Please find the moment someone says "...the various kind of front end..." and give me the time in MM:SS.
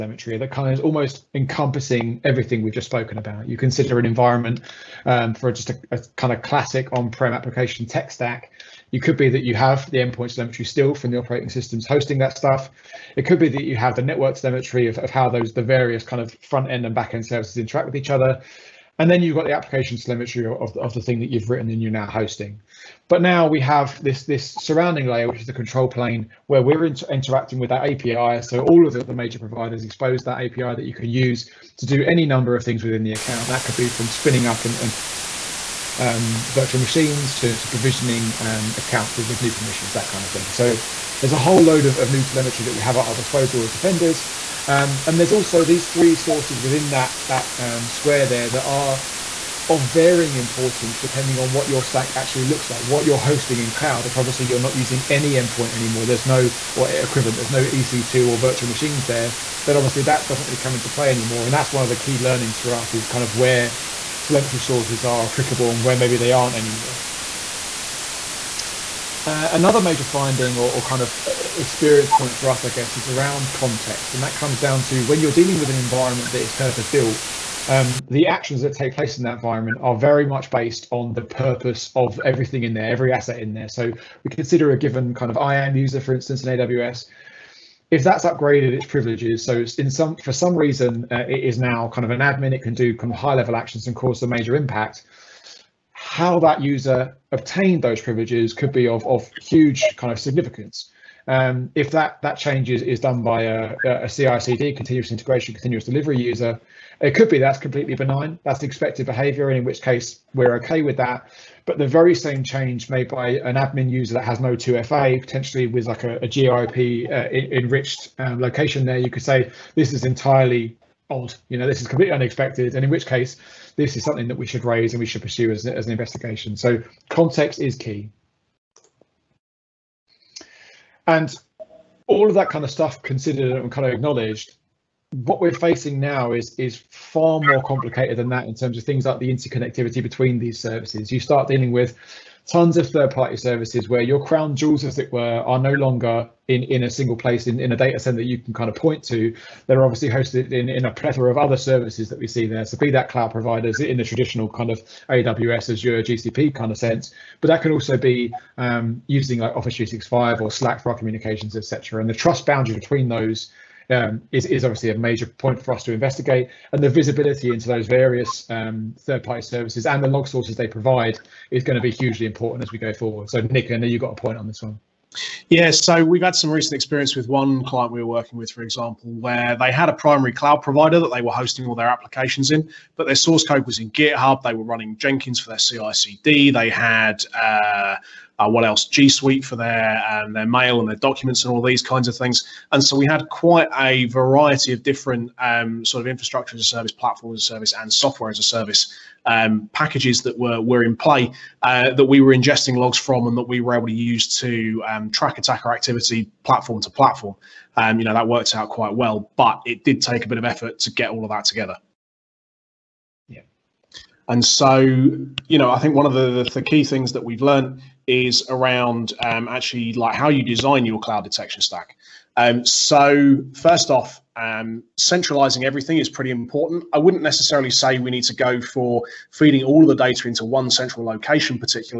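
00:15.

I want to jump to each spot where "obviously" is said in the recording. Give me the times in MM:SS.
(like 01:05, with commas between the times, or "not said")
00:54, 00:59, 02:29, 02:44.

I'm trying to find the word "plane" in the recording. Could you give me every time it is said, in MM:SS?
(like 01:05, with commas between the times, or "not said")
00:25.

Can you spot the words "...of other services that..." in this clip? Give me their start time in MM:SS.
02:31.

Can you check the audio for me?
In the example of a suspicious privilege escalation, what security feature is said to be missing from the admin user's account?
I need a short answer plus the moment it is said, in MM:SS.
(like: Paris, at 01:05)
2FA, at 01:54.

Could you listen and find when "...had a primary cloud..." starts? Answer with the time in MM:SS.
02:59.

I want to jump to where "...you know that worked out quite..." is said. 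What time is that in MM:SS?
03:27.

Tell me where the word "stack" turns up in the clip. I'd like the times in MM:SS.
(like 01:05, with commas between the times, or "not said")
00:08, 00:51, 03:41.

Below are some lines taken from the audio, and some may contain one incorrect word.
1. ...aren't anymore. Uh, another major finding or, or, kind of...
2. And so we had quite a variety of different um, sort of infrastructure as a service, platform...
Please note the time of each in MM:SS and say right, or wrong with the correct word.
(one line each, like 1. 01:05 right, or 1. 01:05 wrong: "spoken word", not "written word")
1. 01:06 right
2. 03:12 right.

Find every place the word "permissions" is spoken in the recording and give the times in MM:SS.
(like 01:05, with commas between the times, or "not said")
00:39.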